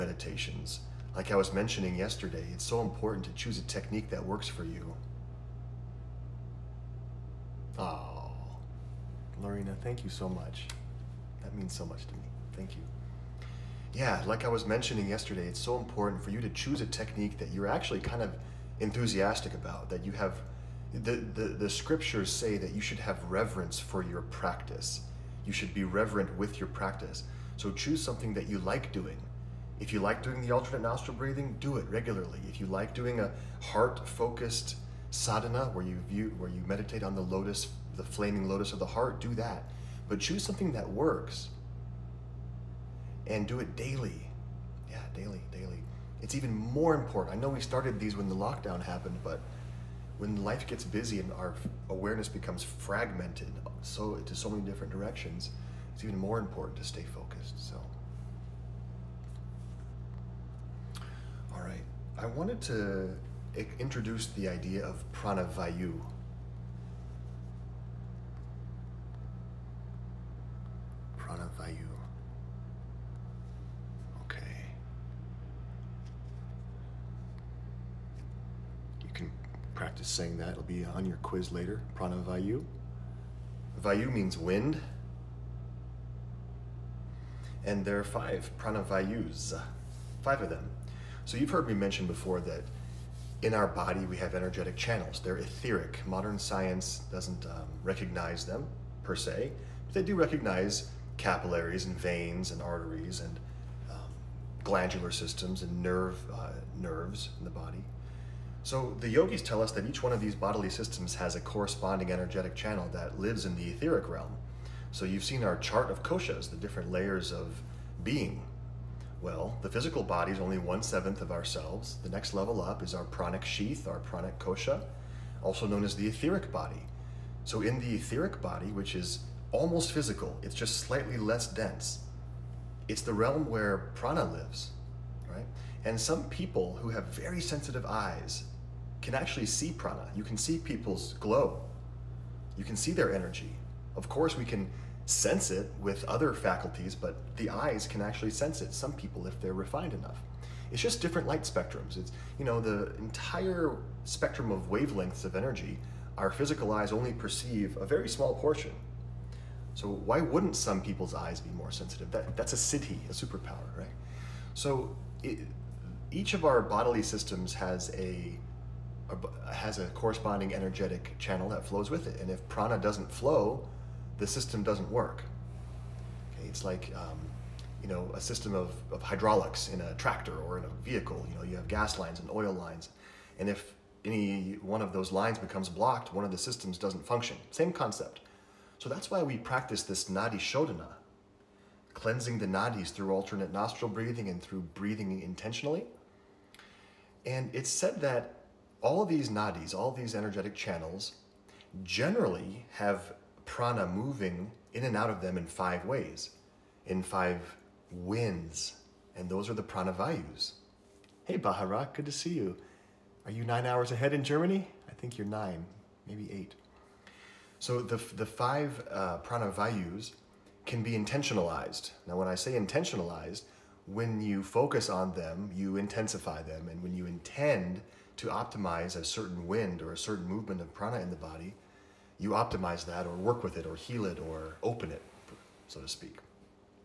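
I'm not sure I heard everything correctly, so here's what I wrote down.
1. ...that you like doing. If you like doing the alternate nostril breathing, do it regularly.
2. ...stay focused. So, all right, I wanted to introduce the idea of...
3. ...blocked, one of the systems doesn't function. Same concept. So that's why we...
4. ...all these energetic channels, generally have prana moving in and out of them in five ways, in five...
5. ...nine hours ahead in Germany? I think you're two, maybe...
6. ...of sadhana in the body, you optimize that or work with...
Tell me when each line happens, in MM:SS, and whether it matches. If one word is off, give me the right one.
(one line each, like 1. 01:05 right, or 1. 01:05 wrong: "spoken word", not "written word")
1. 00:28 right
2. 00:56 right
3. 03:05 right
4. 03:19 right
5. 03:33 wrong: "nine", not "two"
6. 03:50 wrong: "prana", not "sadhana".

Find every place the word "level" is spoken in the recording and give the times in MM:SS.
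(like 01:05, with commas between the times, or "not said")
02:02.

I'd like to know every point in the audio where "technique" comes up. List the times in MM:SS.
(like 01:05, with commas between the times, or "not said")
00:03, 00:16.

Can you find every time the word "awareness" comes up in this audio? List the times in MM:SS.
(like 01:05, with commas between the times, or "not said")
00:51.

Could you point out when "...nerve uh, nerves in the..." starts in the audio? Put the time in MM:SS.
01:45.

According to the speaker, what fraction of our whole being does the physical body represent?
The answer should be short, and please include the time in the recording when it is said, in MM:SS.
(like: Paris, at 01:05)
One seventh, at 02:00.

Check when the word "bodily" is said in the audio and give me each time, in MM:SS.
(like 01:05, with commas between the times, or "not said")
01:50, 02:46.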